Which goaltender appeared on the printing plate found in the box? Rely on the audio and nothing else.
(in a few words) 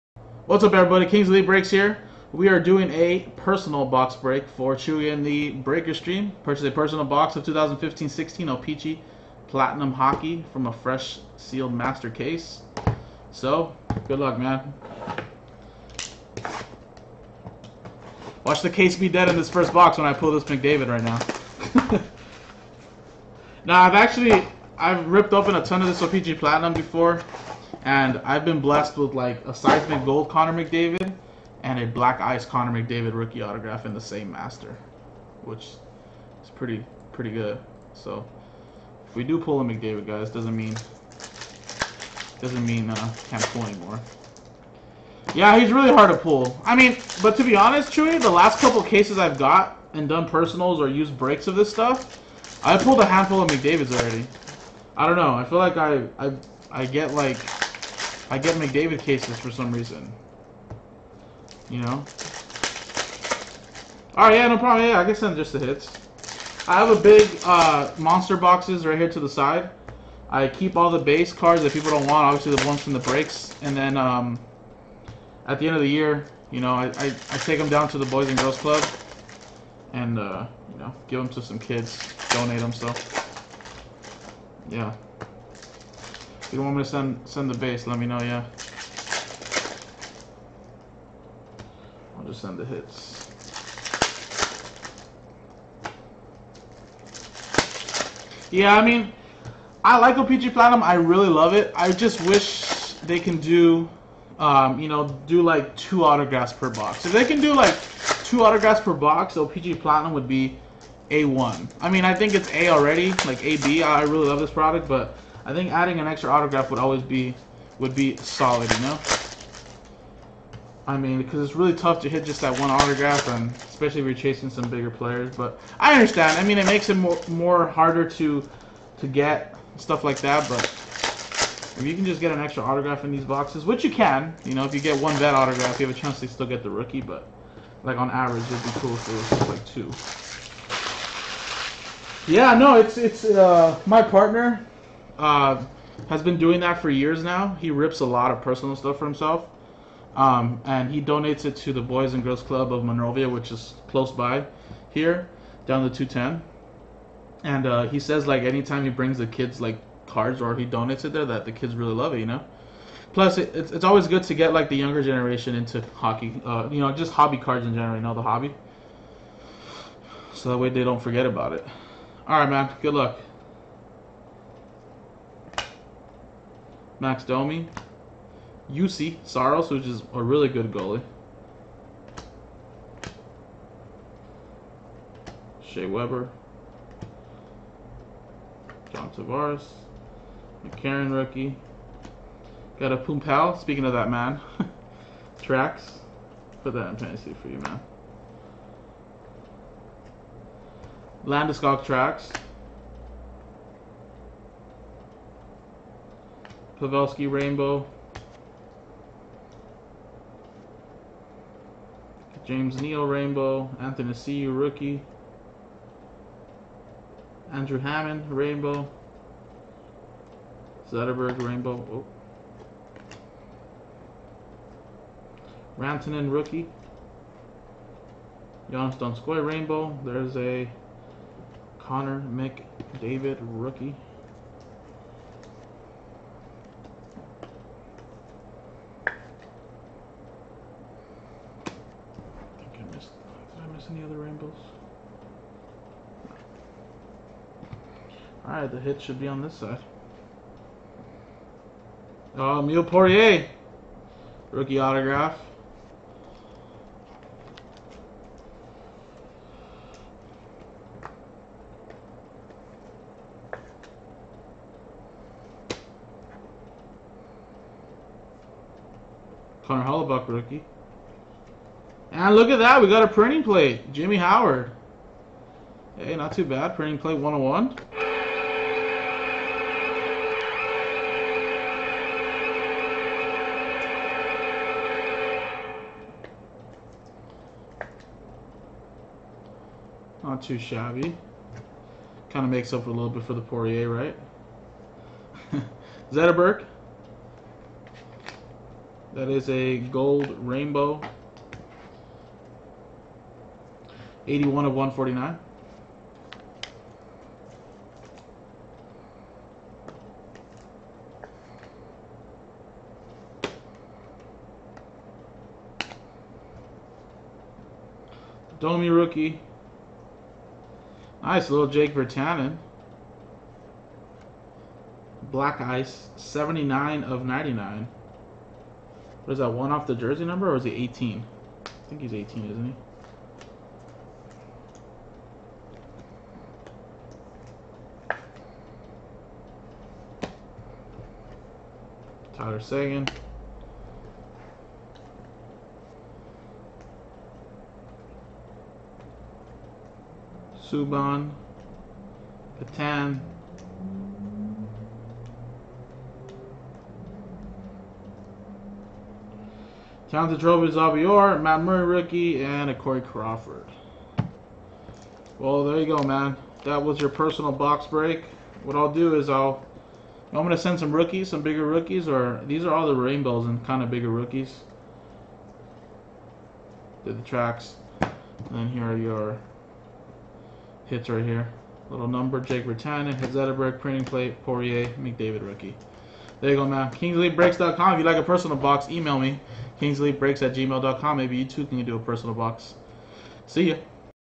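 Jimmy Howard.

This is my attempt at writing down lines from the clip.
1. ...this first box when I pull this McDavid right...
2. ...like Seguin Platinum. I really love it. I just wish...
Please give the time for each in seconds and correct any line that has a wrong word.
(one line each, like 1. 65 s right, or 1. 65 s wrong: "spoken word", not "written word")
1. 19 s right
2. 99 s wrong: "OPC", not "Seguin".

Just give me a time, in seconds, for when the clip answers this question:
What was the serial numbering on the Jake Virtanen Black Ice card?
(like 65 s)
326 s.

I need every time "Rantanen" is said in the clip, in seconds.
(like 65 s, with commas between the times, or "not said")
225 s.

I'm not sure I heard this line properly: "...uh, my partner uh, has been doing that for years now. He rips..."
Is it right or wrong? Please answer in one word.
right.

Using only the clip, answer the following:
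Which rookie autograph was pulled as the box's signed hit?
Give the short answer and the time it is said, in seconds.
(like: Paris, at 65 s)
Emile Poirier, at 252 s.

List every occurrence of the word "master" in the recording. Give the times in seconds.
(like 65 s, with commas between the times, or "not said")
11 s, 34 s.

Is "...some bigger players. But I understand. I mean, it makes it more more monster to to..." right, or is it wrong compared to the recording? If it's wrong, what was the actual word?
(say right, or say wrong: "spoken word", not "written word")
wrong: "harder", not "monster".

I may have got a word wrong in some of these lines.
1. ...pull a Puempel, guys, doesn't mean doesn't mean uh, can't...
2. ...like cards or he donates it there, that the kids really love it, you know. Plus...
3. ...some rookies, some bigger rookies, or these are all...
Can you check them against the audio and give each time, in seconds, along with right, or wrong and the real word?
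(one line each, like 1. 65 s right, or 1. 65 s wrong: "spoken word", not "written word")
1. 39 s wrong: "McDavid", not "Puempel"
2. 159 s right
3. 370 s right.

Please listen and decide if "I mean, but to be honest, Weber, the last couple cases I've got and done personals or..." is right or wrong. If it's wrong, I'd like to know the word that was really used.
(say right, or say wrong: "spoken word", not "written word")
wrong: "Chewy", not "Weber".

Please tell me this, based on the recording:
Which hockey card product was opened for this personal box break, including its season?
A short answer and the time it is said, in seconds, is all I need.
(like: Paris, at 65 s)
2015-16 O-Pee-Chee Platinum, at 7 s.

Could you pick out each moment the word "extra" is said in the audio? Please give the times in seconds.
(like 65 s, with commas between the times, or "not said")
116 s, 132 s.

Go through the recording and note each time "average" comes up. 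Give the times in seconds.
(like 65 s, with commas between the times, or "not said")
138 s.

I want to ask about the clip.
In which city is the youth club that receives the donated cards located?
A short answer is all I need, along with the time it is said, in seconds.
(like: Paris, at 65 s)
Monrovia, at 152 s.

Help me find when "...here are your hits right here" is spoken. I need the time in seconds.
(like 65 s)
378 s.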